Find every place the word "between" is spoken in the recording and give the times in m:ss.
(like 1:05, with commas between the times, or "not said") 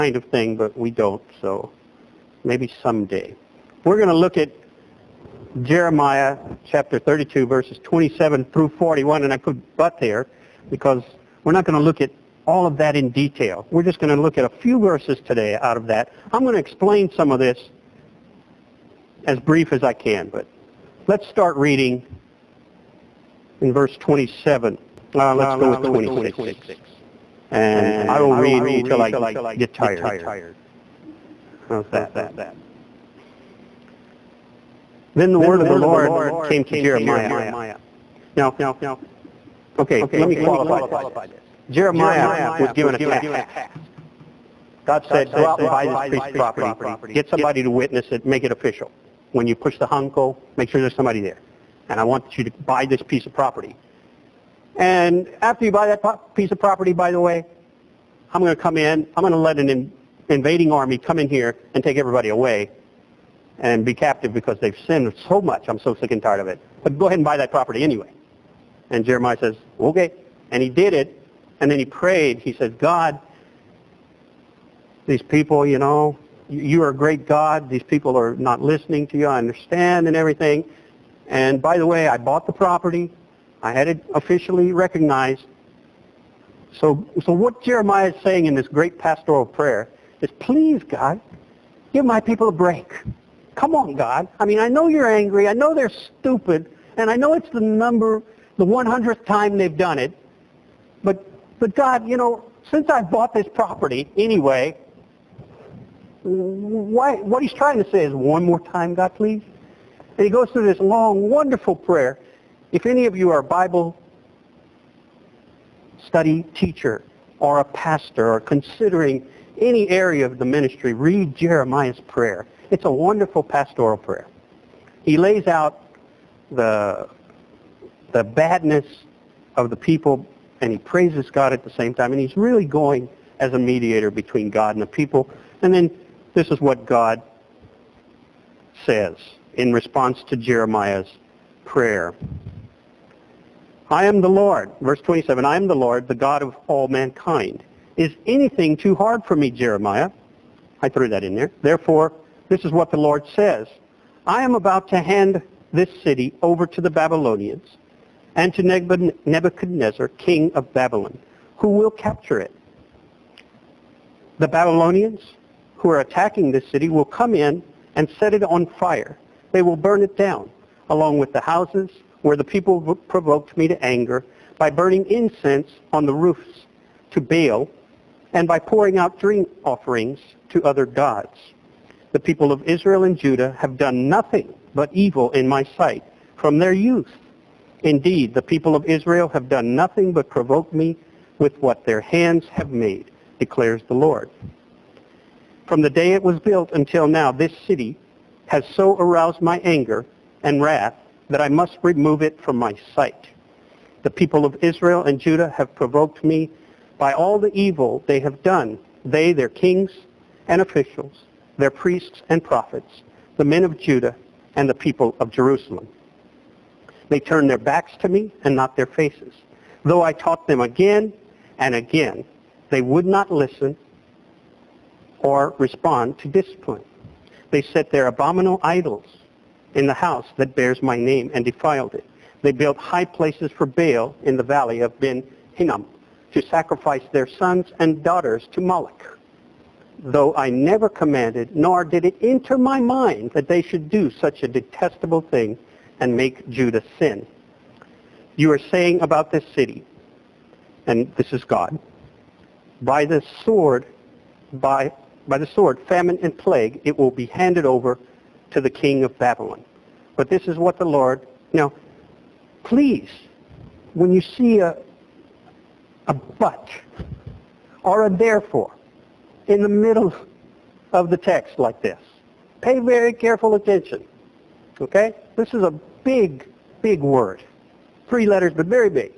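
2:14.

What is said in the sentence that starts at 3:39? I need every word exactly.
Though I taught them again and again, they would not listen or respond to discipline.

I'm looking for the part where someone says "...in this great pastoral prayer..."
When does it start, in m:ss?
1:28.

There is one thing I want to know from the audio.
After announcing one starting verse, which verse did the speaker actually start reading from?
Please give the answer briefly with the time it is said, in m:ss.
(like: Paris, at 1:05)
26, at 0:25.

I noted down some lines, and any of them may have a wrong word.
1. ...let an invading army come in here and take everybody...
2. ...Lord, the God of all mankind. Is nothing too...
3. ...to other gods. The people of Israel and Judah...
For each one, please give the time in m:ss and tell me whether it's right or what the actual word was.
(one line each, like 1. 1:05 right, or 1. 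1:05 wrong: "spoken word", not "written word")
1. 0:59 right
2. 2:25 wrong: "anything", not "nothing"
3. 3:00 right.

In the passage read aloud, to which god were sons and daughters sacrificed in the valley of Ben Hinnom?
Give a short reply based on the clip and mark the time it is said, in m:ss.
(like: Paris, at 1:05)
Moloch, at 3:58.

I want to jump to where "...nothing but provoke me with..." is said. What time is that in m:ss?
3:09.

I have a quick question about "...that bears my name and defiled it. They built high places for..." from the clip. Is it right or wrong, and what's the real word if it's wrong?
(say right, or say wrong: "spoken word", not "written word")
right.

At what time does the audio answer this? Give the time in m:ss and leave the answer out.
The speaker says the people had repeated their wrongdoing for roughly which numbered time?
1:38.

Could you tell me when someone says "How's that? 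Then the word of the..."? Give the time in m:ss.
0:31.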